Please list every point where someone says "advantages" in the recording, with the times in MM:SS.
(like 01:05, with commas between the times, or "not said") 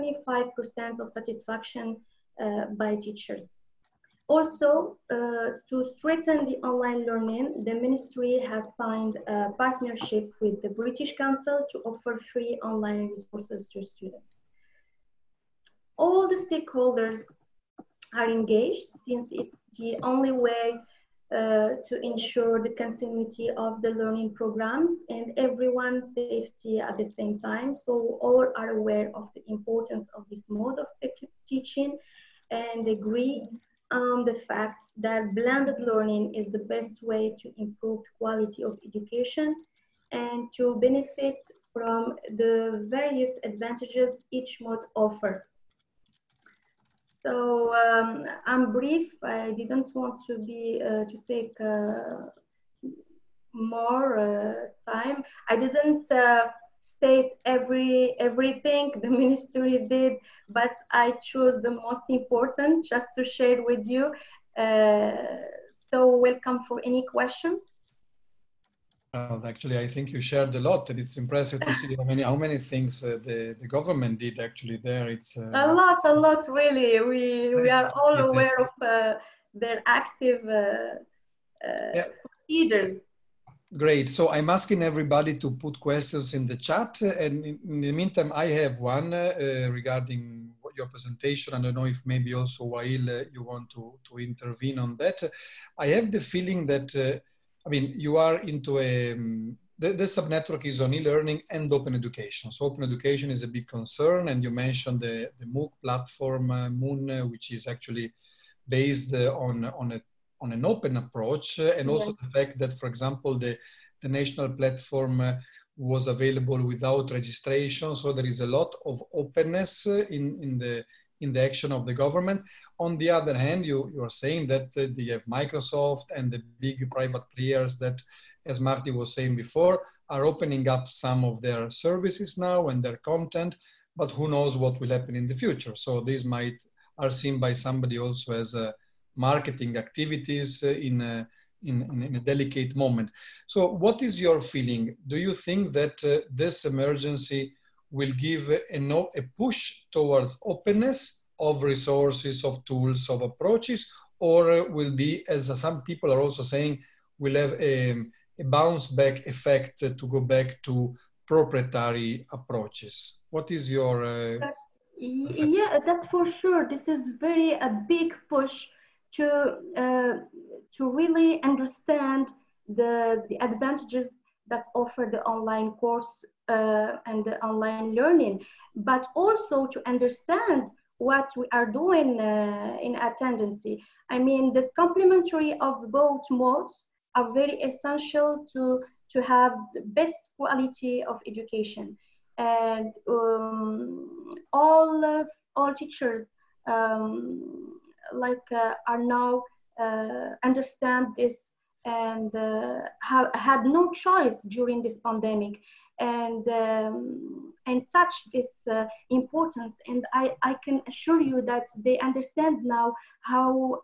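00:43, 02:53.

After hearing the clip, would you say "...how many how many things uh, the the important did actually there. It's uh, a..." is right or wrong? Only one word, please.
wrong.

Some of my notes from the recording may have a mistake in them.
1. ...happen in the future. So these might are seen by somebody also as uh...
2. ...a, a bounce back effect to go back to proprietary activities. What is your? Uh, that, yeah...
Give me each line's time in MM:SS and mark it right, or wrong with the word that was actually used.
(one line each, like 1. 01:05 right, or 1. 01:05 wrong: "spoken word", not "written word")
1. 02:14 right
2. 02:37 wrong: "approaches", not "activities".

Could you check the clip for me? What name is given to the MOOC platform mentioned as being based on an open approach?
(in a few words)
Moon.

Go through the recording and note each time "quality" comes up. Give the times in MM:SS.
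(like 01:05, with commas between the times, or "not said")
00:38, 03:10.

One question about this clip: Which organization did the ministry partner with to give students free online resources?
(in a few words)
British Council.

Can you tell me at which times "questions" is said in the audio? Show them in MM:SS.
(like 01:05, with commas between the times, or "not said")
01:07, 01:25.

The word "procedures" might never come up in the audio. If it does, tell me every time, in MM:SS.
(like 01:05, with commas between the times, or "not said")
01:22.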